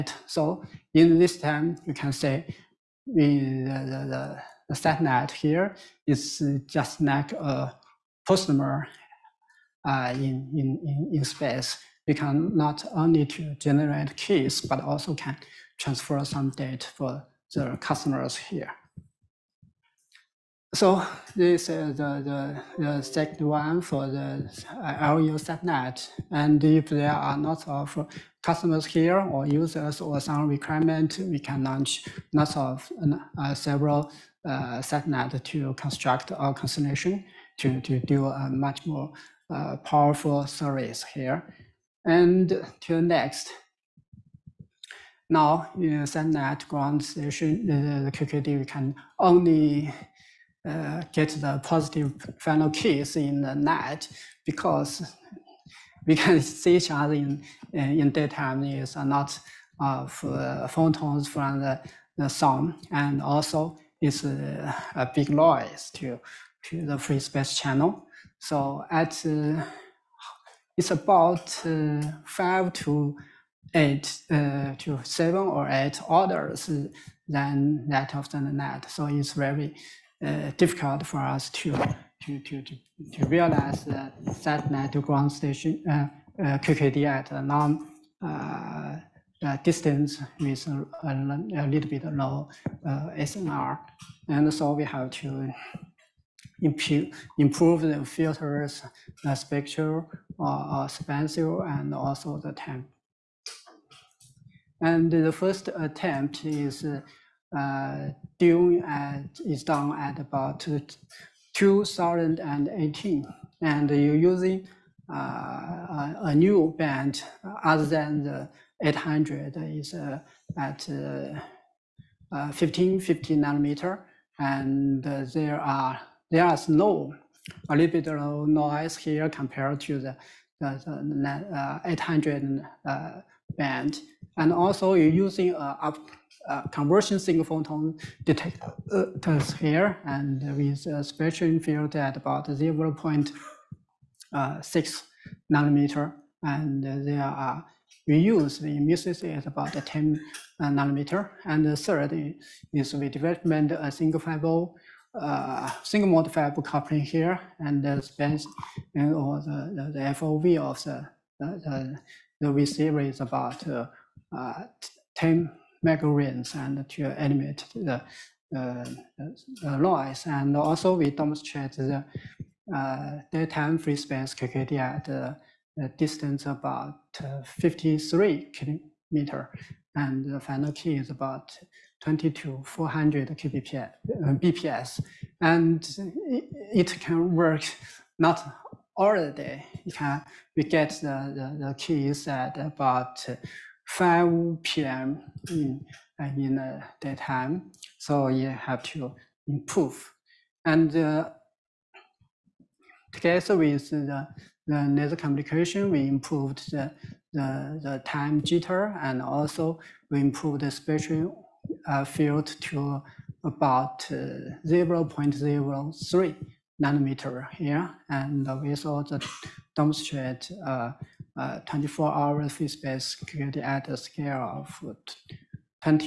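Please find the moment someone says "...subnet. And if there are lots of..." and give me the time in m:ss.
0:25.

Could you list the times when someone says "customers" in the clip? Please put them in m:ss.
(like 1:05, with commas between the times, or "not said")
0:08, 0:17, 0:28.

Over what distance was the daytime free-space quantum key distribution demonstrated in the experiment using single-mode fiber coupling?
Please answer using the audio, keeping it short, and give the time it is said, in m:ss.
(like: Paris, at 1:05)
53 kilometers, at 2:57.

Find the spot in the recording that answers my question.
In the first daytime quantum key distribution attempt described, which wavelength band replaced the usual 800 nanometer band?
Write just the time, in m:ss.
2:02.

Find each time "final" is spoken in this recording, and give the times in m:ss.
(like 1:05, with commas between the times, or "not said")
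0:52, 3:00.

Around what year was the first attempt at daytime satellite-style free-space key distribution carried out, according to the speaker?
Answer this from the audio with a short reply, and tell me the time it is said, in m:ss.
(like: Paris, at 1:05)
2018, at 1:51.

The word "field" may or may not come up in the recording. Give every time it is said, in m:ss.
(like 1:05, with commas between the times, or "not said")
2:21, 3:32.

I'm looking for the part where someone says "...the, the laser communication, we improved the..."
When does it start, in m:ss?
3:23.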